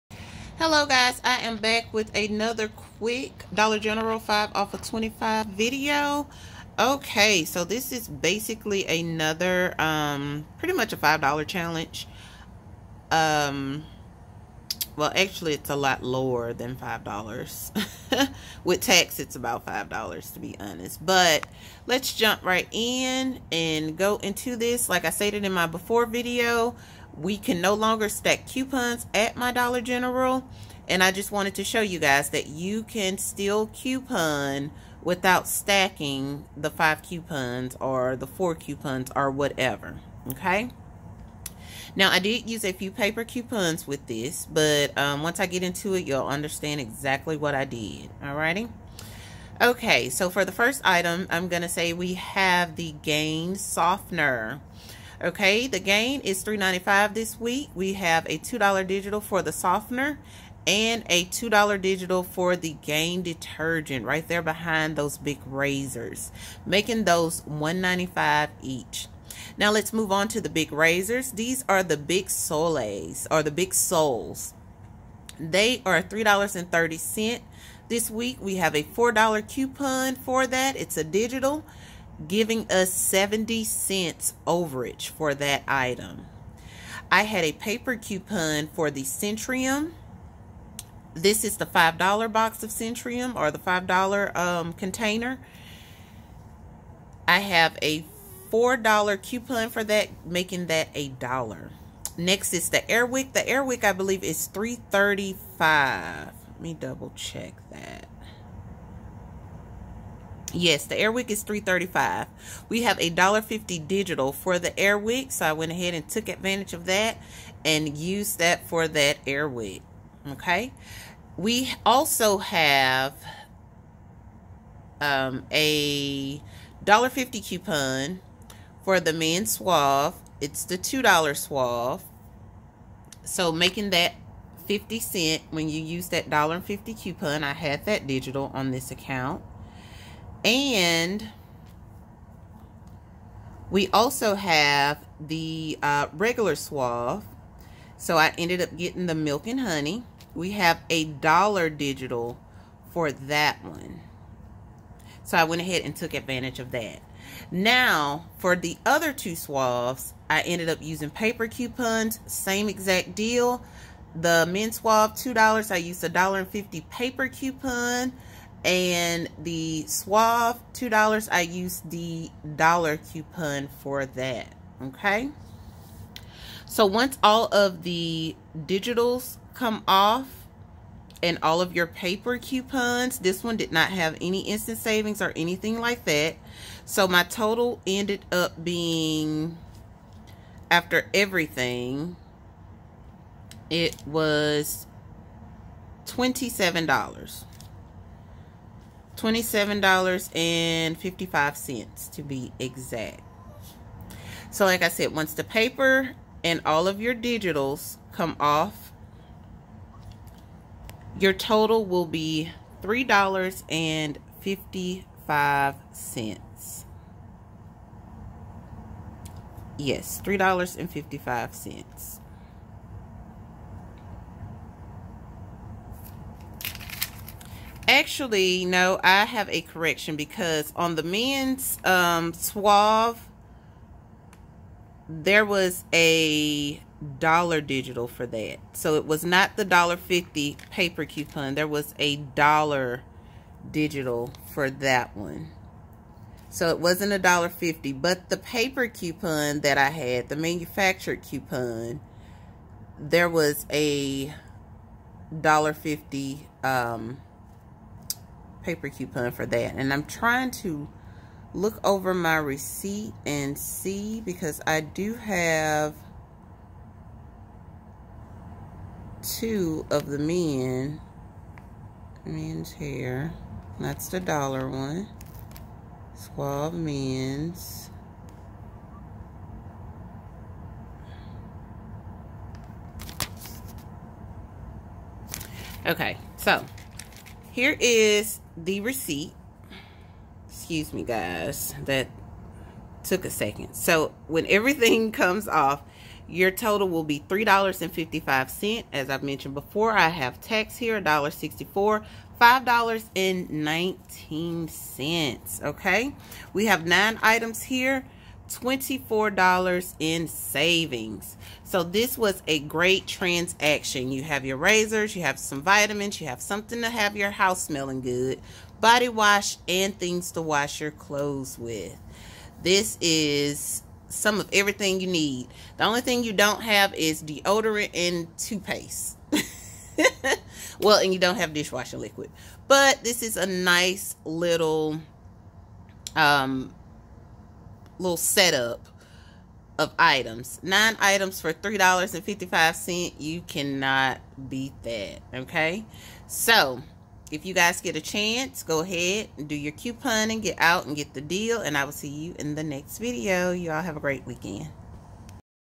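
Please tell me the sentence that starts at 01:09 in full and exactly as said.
Now let's move on to the Bic razors.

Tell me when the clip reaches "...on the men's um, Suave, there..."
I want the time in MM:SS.
03:50.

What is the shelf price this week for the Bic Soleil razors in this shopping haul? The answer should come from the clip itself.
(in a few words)
$3.30.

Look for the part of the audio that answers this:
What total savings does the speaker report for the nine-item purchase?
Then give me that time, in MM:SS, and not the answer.
05:08.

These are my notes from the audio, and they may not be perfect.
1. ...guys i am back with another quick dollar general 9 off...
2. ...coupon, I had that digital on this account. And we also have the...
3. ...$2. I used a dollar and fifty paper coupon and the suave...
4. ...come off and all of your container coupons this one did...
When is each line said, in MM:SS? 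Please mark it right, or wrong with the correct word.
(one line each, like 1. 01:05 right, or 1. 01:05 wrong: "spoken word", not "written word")
1. 00:00 wrong: "5", not "9"
2. 02:17 right
3. 02:45 right
4. 02:59 wrong: "paper", not "container".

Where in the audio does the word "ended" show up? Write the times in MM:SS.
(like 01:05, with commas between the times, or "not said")
02:28, 02:40, 03:07.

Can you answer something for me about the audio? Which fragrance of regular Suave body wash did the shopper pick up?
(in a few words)
Milk and Honey.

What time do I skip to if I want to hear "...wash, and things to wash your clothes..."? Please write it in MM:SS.
05:19.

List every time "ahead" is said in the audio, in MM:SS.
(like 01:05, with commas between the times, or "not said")
01:55, 02:35, 05:48.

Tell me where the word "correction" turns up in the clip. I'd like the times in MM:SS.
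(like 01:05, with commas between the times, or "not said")
03:49.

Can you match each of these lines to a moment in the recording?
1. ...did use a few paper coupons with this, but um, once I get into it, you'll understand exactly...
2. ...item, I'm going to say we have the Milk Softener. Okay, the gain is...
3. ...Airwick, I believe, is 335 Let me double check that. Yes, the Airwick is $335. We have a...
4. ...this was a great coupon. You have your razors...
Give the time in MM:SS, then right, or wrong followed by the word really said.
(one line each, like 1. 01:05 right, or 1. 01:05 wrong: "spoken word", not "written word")
1. 00:42 right
2. 00:50 wrong: "Gain", not "Milk"
3. 01:43 right
4. 05:11 wrong: "transaction", not "coupon".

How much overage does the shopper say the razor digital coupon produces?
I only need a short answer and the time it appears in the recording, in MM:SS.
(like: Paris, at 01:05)
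70 cents, at 01:22.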